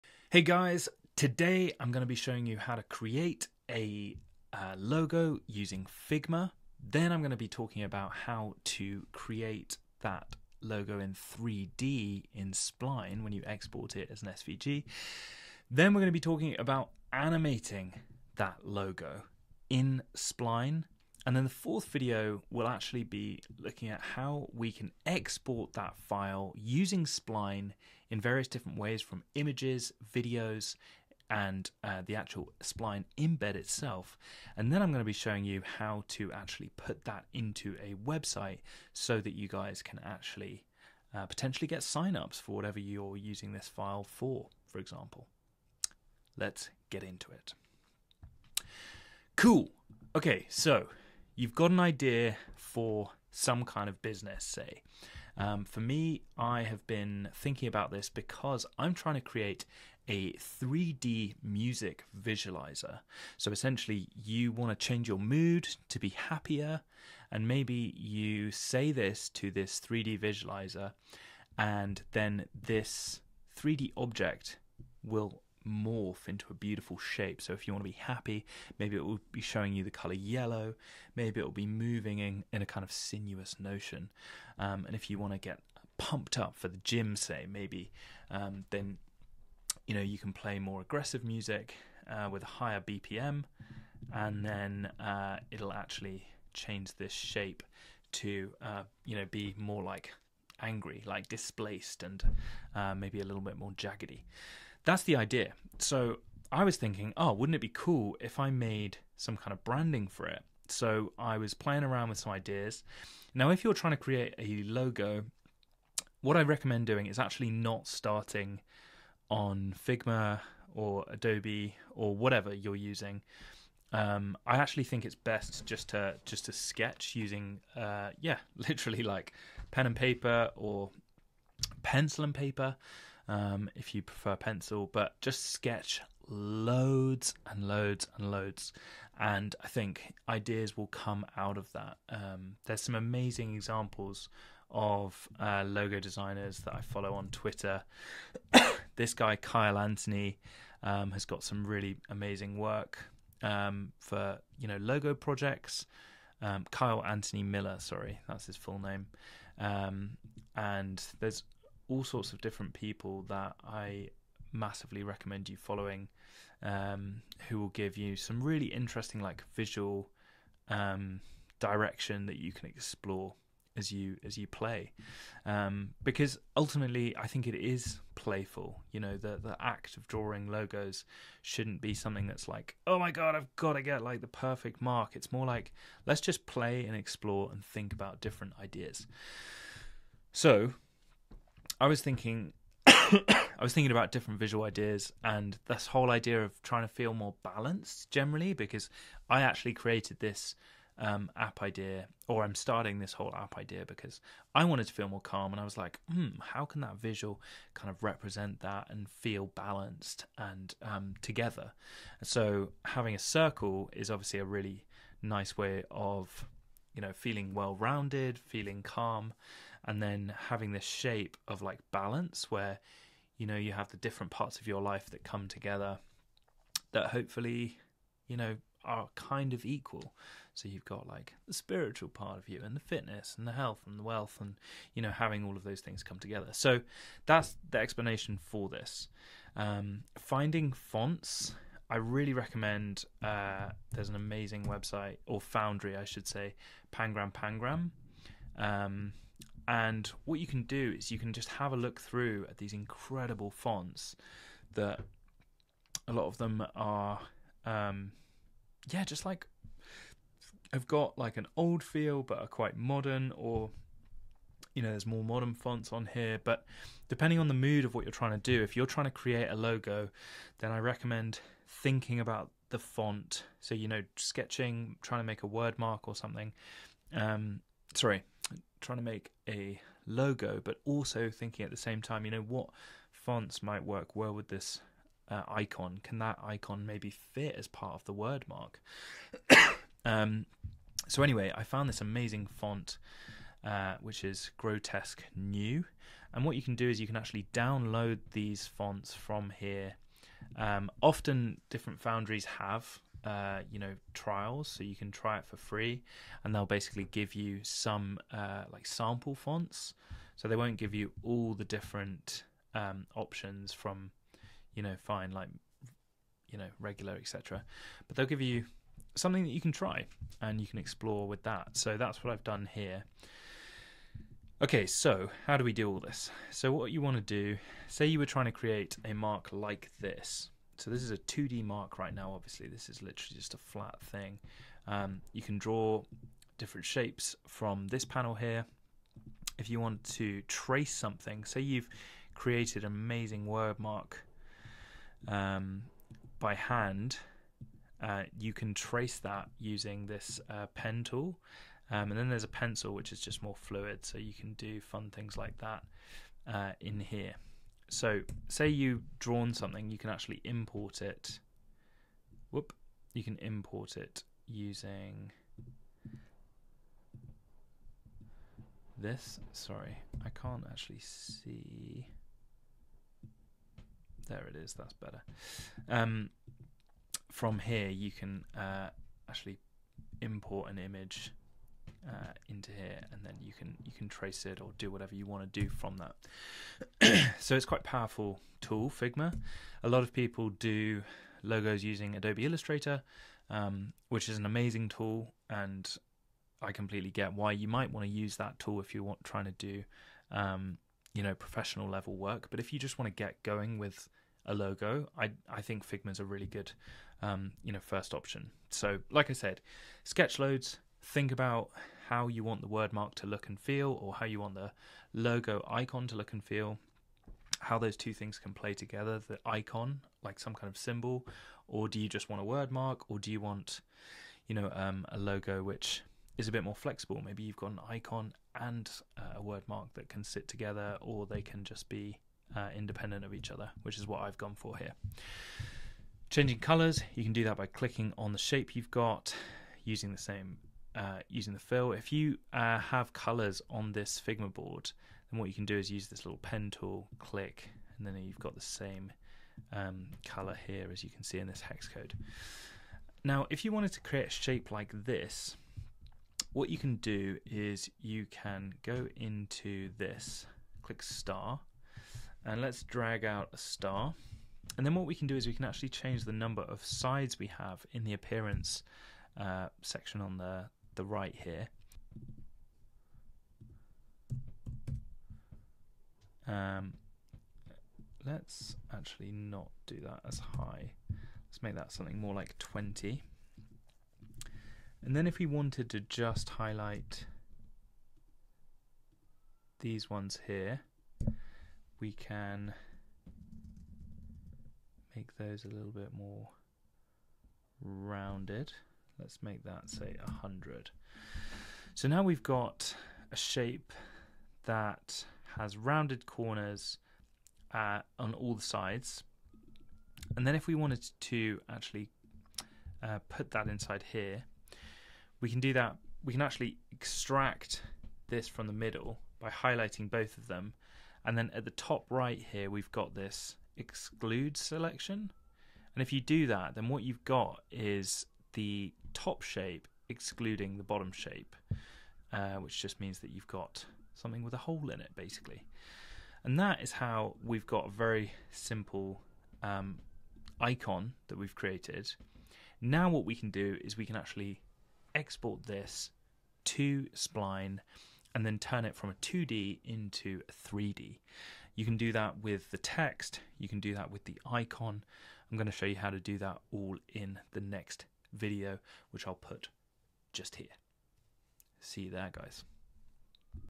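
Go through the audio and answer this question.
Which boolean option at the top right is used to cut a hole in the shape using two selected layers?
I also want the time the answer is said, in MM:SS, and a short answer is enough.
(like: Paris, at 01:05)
exclude selection, at 08:43.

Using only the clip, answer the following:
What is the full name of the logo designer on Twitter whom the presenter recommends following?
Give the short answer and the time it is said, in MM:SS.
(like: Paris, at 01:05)
Kyle Anthony Miller, at 02:36.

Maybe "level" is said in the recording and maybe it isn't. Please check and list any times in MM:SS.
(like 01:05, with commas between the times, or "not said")
06:41.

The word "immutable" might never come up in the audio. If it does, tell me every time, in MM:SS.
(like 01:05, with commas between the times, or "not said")
not said.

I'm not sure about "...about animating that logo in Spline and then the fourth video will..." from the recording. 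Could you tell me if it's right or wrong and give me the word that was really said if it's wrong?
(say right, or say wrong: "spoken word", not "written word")
right.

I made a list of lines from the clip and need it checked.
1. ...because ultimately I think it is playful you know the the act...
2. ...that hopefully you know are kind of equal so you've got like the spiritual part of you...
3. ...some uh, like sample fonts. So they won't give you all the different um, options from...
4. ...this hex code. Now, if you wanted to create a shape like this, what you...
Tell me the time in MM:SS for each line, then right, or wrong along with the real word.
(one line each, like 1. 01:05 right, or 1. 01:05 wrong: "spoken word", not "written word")
1. 02:56 right
2. 03:46 right
3. 05:07 right
4. 07:31 right.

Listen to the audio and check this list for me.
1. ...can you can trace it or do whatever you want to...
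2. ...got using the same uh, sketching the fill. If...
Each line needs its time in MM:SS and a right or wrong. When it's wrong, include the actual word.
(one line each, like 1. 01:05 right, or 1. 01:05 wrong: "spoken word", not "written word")
1. 06:23 right
2. 07:18 wrong: "using", not "sketching".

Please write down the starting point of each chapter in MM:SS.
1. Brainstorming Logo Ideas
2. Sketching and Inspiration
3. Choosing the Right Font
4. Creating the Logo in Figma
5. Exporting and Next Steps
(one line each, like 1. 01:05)
1. 00:50
2. 01:50
3. 03:59
4. 05:24
5. 09:02.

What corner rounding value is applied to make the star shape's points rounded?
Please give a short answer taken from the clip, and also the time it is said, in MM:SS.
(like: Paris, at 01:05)
100, at 08:20.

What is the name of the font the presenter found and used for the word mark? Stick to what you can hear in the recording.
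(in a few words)
Grotesque New.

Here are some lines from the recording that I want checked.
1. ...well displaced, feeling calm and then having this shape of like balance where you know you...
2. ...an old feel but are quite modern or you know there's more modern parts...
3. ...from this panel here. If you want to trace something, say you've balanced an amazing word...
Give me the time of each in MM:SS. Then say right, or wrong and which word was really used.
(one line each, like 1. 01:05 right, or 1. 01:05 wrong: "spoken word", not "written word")
1. 03:37 wrong: "rounded", not "displaced"
2. 04:21 wrong: "fonts", not "parts"
3. 05:37 wrong: "created", not "balanced".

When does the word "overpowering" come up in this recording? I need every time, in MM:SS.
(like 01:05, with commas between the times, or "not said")
not said.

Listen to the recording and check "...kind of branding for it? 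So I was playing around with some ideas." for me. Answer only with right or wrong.
right.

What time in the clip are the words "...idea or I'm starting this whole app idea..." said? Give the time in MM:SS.
03:21.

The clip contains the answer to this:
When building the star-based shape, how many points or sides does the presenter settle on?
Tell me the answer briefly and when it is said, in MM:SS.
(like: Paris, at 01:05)
20, at 08:02.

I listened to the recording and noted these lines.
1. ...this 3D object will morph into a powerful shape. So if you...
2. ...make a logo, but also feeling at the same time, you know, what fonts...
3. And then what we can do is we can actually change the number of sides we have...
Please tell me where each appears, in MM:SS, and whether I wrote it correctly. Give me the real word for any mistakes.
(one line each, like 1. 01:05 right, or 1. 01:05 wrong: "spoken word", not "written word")
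1. 01:12 wrong: "beautiful", not "powerful"
2. 04:39 wrong: "thinking", not "feeling"
3. 07:44 right.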